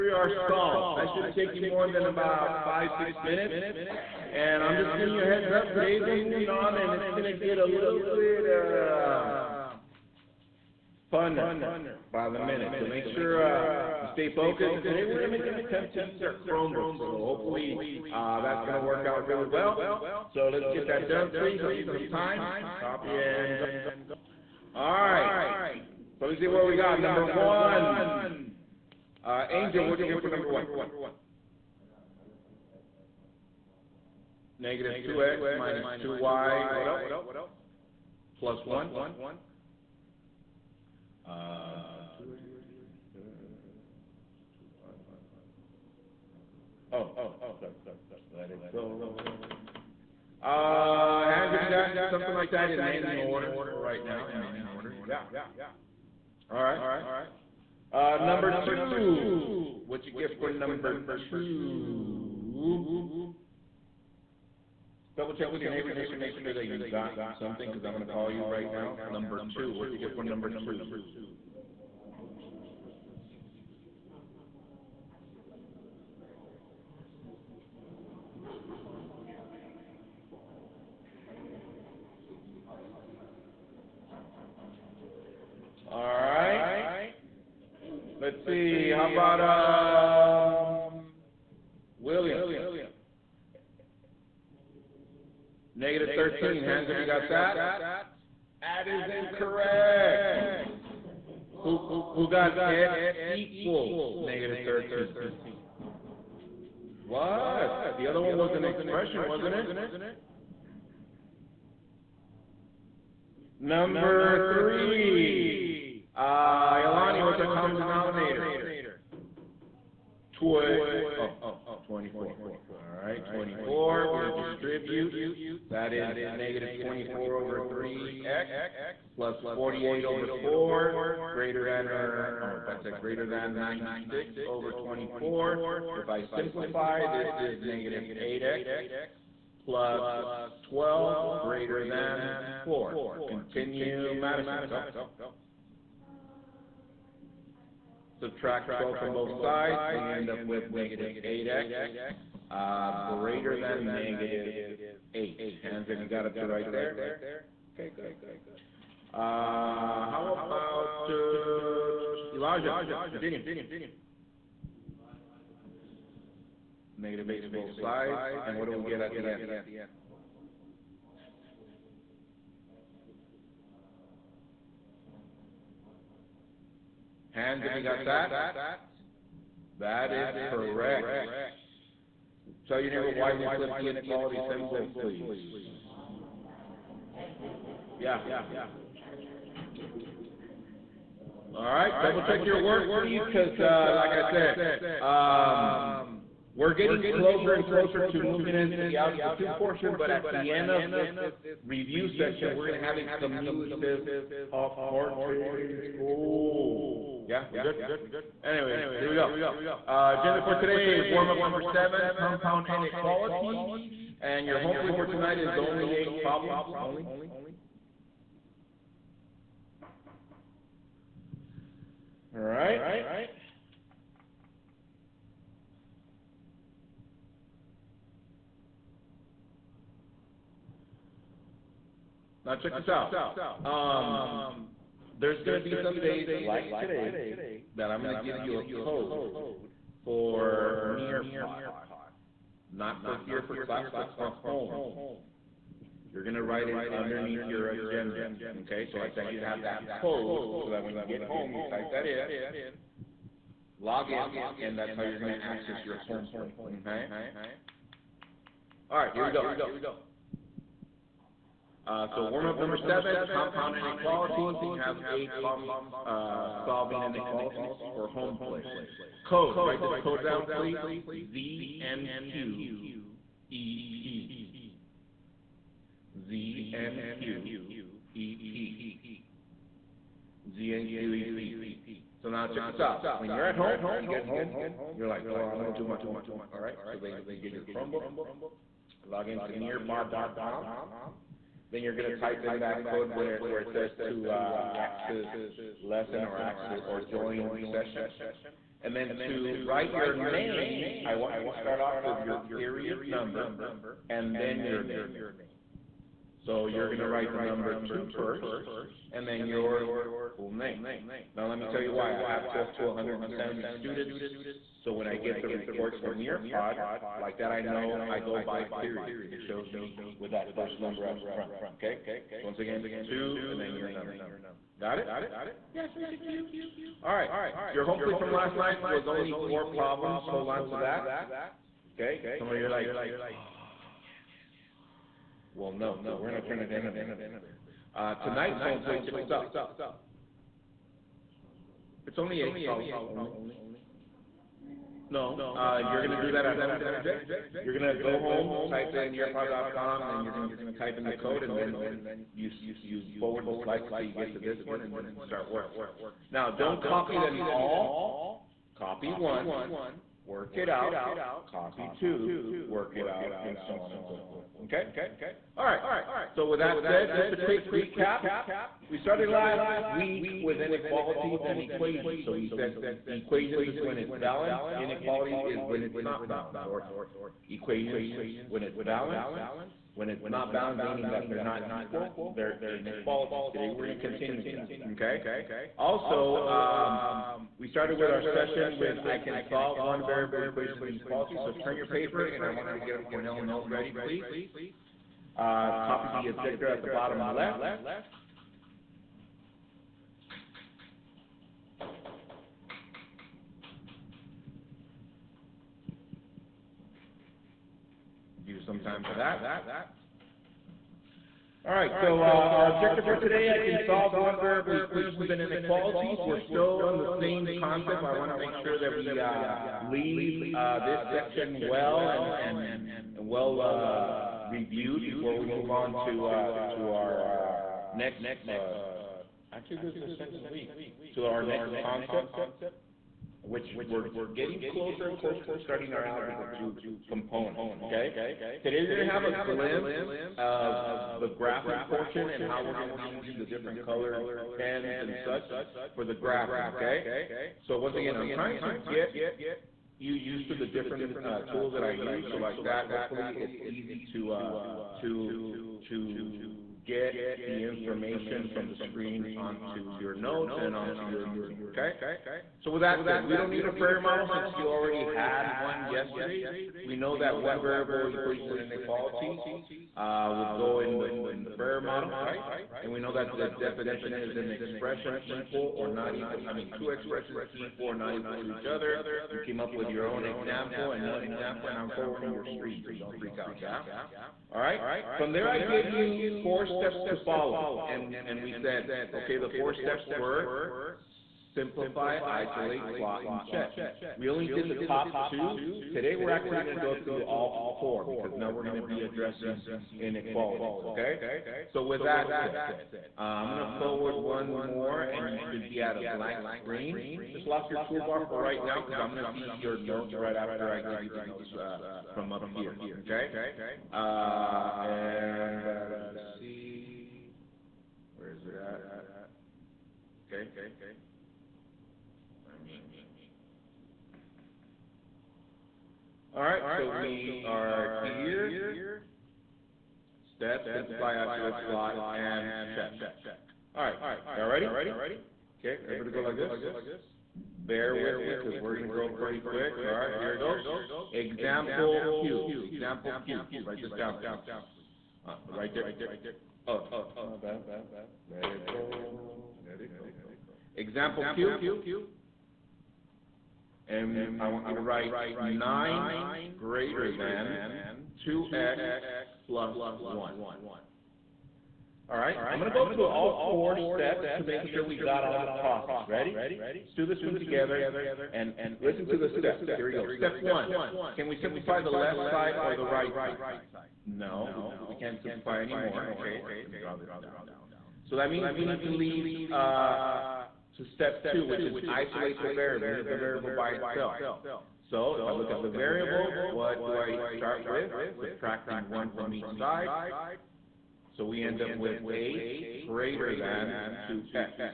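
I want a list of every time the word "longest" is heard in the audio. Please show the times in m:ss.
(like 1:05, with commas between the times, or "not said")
not said.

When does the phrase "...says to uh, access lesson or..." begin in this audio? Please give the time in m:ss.
4:53.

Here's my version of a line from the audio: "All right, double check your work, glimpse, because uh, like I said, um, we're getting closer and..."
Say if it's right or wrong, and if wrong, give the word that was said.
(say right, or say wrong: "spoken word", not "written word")
wrong: "please", not "glimpse".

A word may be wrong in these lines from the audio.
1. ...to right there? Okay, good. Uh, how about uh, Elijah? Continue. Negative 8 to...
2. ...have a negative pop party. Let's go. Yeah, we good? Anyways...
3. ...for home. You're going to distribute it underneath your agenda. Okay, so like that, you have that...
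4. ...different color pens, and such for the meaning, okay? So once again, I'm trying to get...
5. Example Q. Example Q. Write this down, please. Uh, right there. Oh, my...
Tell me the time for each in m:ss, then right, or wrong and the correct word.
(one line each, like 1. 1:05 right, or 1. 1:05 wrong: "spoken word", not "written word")
1. 2:36 right
2. 3:22 wrong: "cumulative", not "negative"
3. 4:04 wrong: "write", not "distribute"
4. 7:23 wrong: "graphing", not "meaning"
5. 9:01 right.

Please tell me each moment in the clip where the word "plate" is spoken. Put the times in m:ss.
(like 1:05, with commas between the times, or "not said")
4:16, 4:28, 4:46, 5:28, 5:38.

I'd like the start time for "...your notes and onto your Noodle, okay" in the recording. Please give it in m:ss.
7:39.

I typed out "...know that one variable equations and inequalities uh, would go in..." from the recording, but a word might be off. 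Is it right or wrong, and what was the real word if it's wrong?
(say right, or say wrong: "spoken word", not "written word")
right.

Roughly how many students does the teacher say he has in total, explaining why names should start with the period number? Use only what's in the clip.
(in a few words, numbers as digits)
170.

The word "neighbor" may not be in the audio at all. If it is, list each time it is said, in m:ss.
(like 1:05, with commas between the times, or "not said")
1:05, 3:02.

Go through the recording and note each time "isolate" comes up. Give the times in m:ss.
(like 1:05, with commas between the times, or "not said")
8:12, 8:51, 9:41.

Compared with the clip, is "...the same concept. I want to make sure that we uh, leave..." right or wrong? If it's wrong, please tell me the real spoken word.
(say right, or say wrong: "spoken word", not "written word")
right.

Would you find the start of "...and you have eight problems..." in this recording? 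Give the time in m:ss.
4:24.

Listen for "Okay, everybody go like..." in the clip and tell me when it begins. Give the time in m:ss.
8:55.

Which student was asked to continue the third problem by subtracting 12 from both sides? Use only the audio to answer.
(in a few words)
Madison.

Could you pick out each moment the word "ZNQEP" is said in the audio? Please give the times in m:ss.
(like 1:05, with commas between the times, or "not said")
4:31, 4:40.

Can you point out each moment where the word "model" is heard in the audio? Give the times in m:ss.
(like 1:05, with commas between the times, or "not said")
7:44, 7:51.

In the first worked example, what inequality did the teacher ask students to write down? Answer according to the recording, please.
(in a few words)
9 > 2x + 1.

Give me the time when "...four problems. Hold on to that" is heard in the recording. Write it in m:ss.
5:29.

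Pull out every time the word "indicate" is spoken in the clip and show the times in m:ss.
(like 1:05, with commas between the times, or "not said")
not said.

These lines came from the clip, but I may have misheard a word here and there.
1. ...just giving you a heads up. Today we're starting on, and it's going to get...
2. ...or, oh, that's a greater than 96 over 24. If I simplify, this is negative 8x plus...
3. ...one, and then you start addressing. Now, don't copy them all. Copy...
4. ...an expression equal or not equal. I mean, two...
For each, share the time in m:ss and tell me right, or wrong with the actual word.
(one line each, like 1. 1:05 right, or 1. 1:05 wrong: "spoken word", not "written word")
1. 0:04 wrong: "moving", not "starting"
2. 2:11 right
3. 5:54 wrong: "working", not "addressing"
4. 7:54 right.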